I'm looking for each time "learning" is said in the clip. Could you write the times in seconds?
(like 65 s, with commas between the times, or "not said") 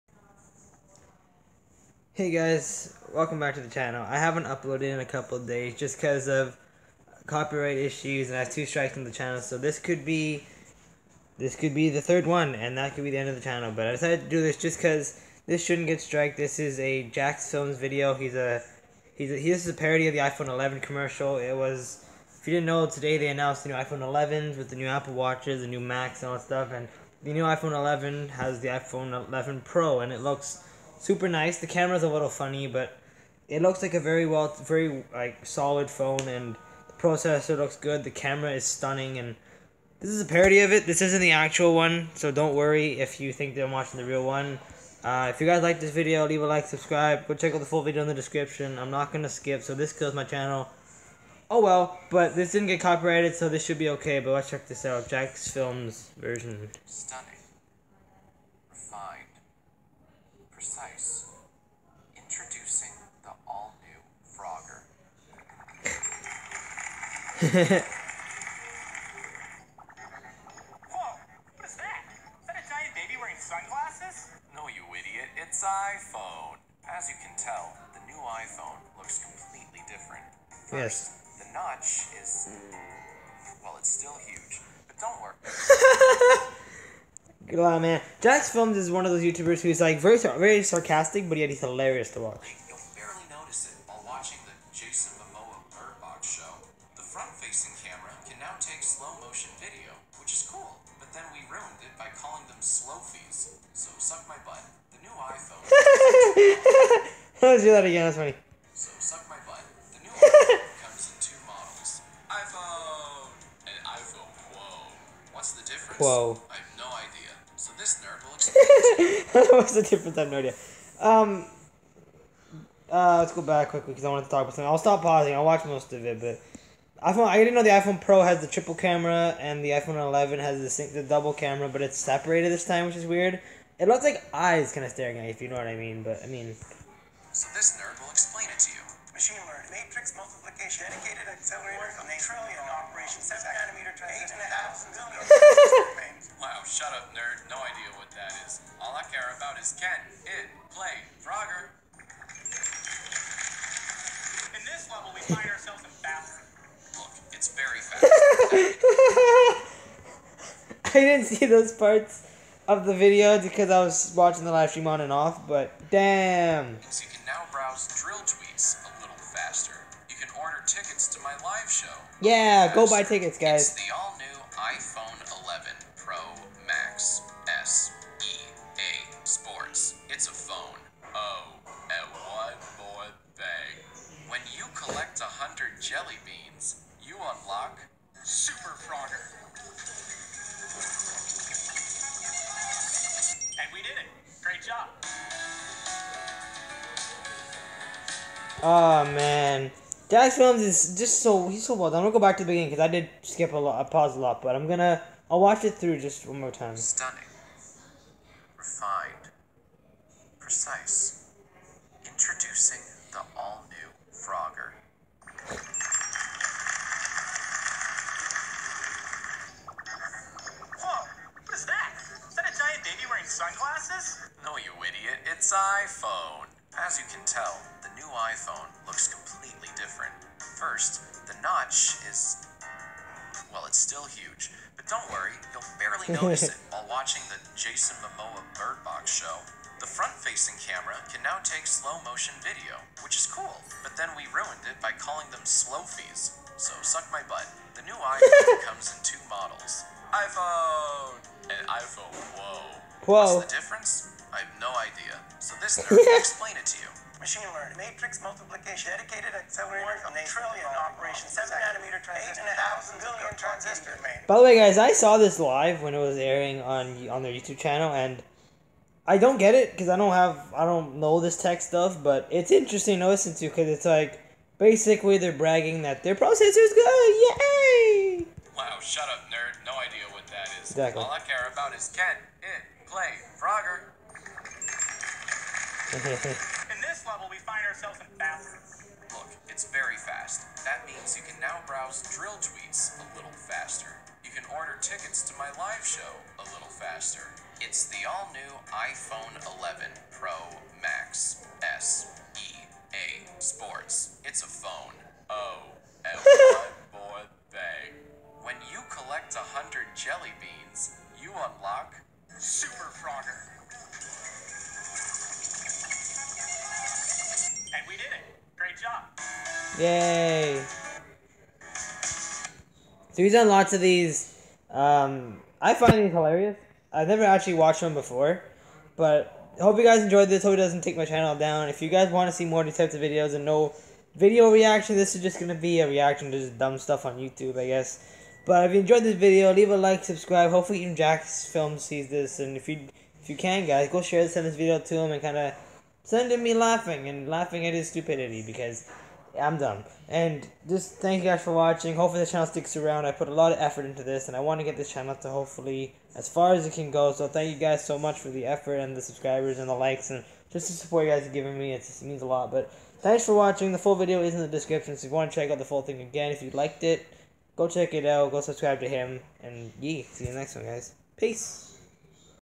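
139 s, 257 s.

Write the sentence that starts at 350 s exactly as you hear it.
And just thank you guys for watching.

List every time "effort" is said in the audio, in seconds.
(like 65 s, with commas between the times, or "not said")
353 s, 358 s.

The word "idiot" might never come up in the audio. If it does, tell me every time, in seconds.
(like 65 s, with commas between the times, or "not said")
74 s, 224 s.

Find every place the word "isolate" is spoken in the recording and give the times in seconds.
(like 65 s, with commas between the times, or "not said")
not said.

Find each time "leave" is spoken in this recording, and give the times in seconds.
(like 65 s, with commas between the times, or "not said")
46 s, 339 s.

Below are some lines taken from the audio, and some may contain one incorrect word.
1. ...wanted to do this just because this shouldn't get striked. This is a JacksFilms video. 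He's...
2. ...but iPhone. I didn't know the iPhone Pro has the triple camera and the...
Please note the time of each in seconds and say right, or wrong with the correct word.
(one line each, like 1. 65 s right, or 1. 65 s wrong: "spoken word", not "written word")
1. 13 s wrong: "decided", not "wanted"
2. 126 s right.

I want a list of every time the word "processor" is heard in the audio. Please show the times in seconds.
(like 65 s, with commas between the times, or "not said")
36 s, 276 s.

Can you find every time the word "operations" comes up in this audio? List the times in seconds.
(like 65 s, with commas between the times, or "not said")
142 s, 260 s.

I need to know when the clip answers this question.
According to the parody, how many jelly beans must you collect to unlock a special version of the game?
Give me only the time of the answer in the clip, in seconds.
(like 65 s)
185 s.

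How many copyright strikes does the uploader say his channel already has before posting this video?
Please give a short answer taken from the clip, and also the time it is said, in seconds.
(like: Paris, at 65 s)
2, at 8 s.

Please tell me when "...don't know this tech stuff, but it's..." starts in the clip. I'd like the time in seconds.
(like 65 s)
270 s.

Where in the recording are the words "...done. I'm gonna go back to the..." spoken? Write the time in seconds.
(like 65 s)
201 s.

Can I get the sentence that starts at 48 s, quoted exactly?
I'm not going to skip, so this kills my channel.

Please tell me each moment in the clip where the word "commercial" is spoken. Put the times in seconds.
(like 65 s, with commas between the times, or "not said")
20 s.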